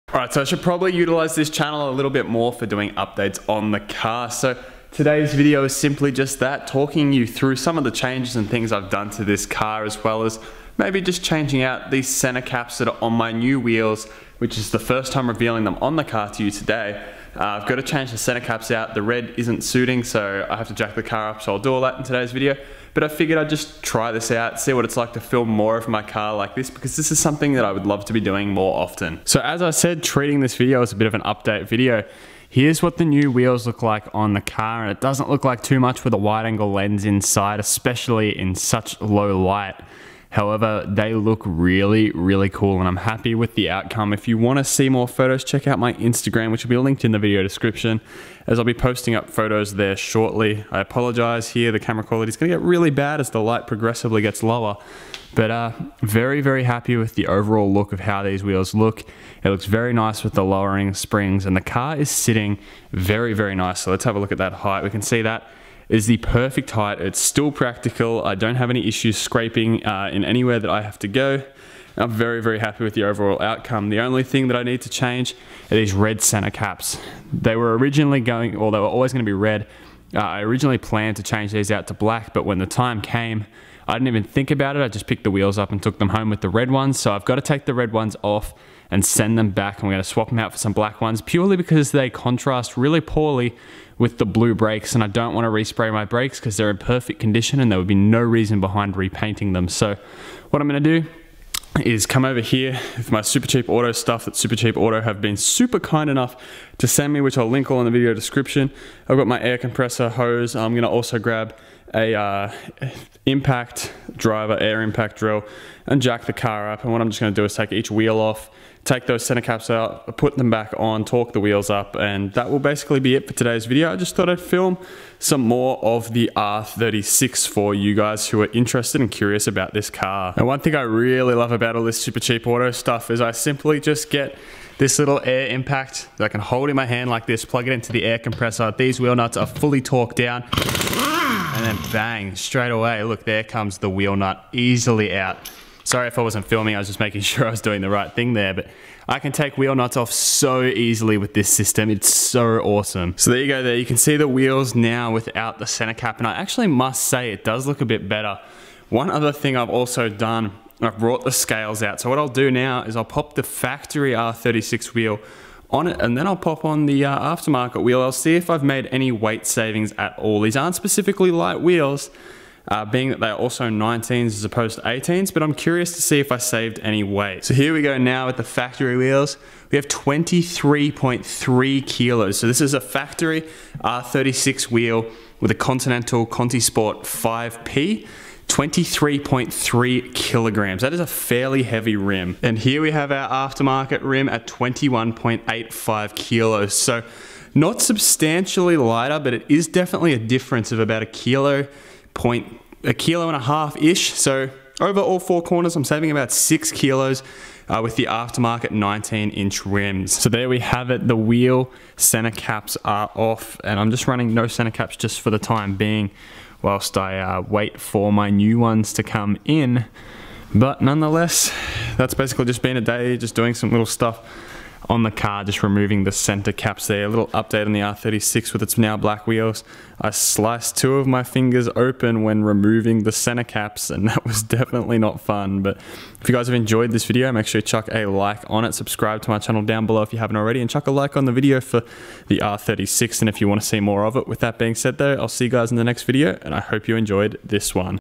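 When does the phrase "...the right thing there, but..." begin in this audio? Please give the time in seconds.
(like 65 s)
147 s.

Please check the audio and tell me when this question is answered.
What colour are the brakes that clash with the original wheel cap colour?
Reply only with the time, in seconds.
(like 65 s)
94 s.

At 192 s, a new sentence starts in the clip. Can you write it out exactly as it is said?
And here we have our aftermarket rim at 21.85 kilos.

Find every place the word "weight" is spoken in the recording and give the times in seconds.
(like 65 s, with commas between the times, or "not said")
169 s, 177 s.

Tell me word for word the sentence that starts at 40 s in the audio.
However, they look really, really cool and I'm happy with the outcome.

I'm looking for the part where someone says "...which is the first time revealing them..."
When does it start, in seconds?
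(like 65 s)
14 s.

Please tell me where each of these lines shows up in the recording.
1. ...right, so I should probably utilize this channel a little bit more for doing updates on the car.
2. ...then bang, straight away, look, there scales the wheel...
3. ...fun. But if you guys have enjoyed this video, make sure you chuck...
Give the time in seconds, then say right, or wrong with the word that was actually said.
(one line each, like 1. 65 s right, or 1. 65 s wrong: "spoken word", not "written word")
1. 0 s right
2. 141 s wrong: "comes", not "scales"
3. 235 s right.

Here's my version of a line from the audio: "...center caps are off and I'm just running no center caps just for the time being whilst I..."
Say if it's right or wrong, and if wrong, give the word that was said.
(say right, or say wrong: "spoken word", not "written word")
right.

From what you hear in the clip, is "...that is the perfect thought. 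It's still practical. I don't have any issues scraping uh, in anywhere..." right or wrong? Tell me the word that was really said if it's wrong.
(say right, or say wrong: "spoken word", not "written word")
wrong: "height", not "thought".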